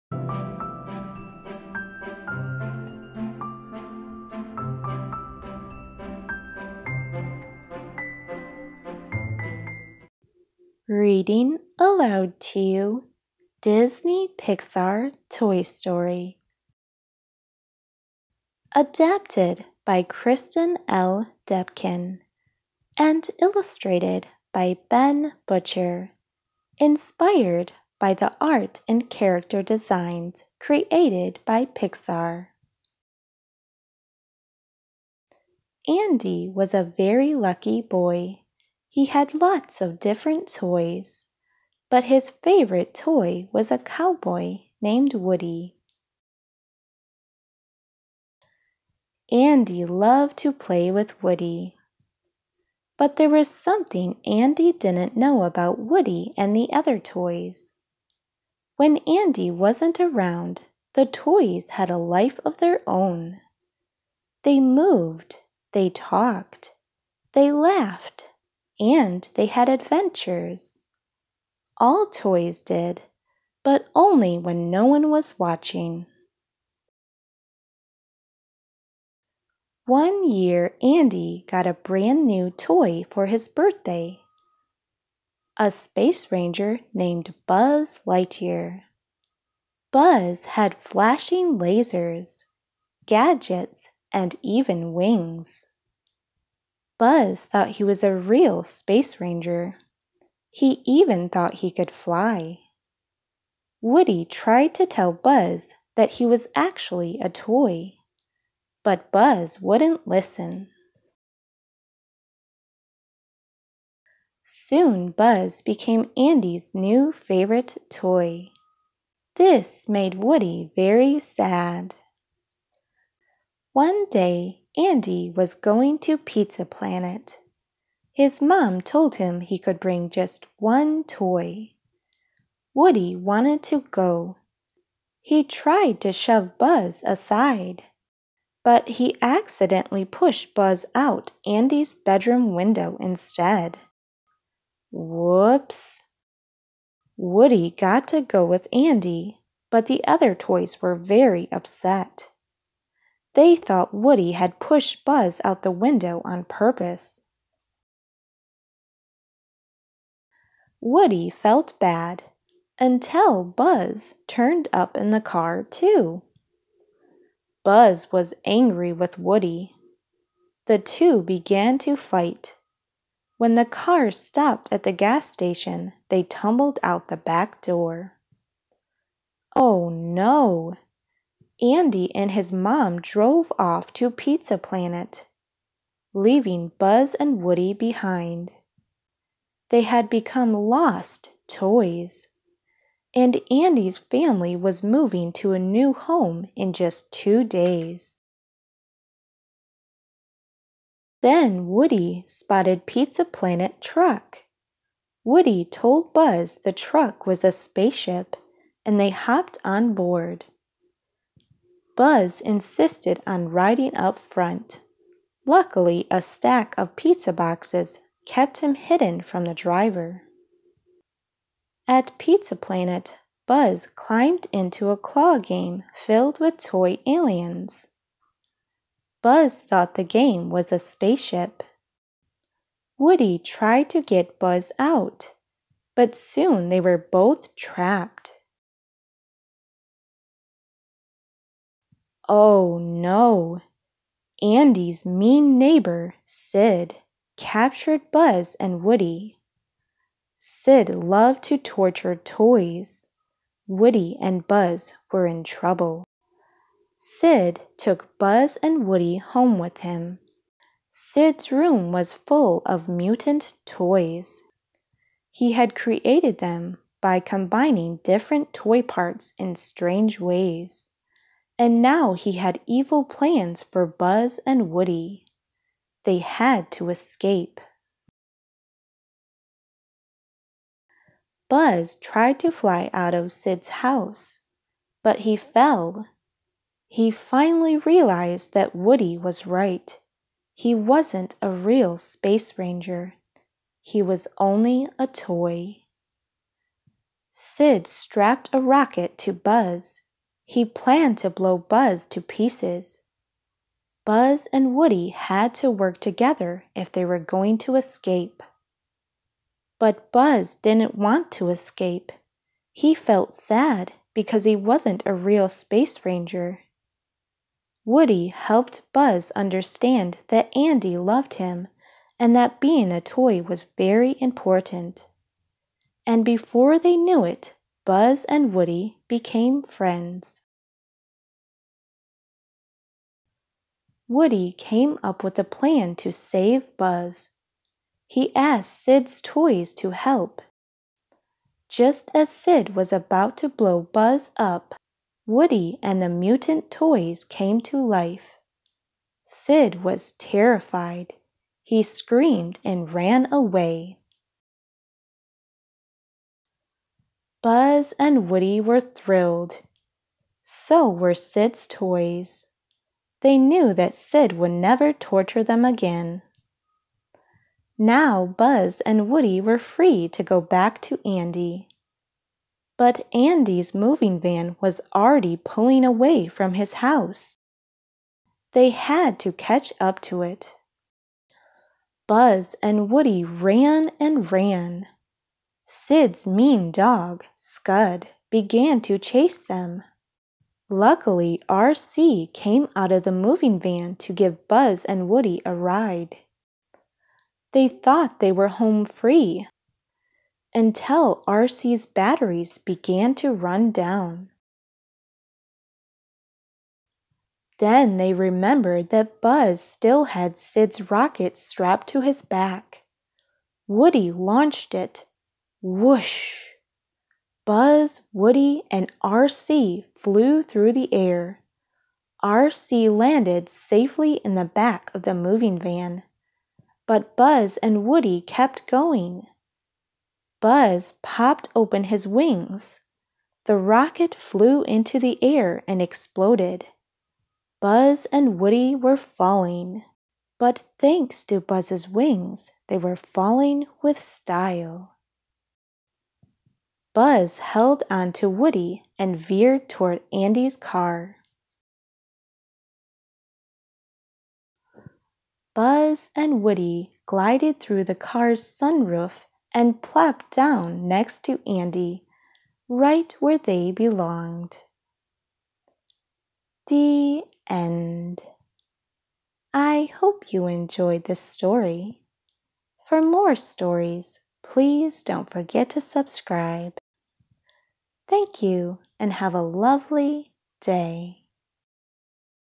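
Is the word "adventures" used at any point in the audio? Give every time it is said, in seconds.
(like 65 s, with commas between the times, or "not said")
69 s.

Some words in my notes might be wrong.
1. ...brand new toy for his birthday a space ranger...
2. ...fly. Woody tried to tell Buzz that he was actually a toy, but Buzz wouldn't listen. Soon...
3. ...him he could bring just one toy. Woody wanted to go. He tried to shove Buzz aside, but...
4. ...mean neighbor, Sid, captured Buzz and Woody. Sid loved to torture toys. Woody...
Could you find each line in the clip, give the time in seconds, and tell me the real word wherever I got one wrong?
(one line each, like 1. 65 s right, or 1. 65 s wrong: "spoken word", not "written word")
1. 81 s right
2. 101 s right
3. 129 s right
4. 245 s right.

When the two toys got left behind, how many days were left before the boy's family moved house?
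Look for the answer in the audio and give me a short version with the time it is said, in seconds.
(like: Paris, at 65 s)
2, at 197 s.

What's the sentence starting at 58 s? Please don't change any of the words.
When Andy wasn't around, the toys had a life of their own.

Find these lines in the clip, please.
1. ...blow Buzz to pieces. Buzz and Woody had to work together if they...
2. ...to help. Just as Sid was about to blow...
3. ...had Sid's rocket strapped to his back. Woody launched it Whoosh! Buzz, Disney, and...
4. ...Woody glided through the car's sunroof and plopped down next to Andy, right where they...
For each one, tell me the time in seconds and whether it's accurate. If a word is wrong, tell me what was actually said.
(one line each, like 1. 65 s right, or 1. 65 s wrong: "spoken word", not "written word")
1. 301 s right
2. 339 s right
3. 410 s wrong: "Woody", not "Disney"
4. 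456 s right.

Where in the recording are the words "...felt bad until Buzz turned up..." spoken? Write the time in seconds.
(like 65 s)
161 s.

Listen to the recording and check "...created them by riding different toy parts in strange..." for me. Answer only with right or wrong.
wrong.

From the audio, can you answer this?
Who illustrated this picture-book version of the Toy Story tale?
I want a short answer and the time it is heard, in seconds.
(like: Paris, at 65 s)
Ben Butcher, at 24 s.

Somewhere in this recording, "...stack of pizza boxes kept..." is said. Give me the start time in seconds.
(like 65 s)
216 s.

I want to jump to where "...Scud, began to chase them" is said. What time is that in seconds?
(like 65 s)
387 s.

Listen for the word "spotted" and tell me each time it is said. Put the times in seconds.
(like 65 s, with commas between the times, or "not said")
202 s.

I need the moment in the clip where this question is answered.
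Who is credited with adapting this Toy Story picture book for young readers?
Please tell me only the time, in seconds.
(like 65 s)
20 s.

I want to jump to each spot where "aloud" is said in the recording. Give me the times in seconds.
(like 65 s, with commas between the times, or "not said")
11 s.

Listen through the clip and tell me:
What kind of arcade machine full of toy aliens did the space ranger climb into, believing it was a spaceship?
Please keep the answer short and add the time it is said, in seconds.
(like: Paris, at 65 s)
A claw game, at 224 s.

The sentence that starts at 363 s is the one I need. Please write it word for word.
They knew that Sid would never torture them again.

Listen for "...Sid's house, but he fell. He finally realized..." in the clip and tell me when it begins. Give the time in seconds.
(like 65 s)
283 s.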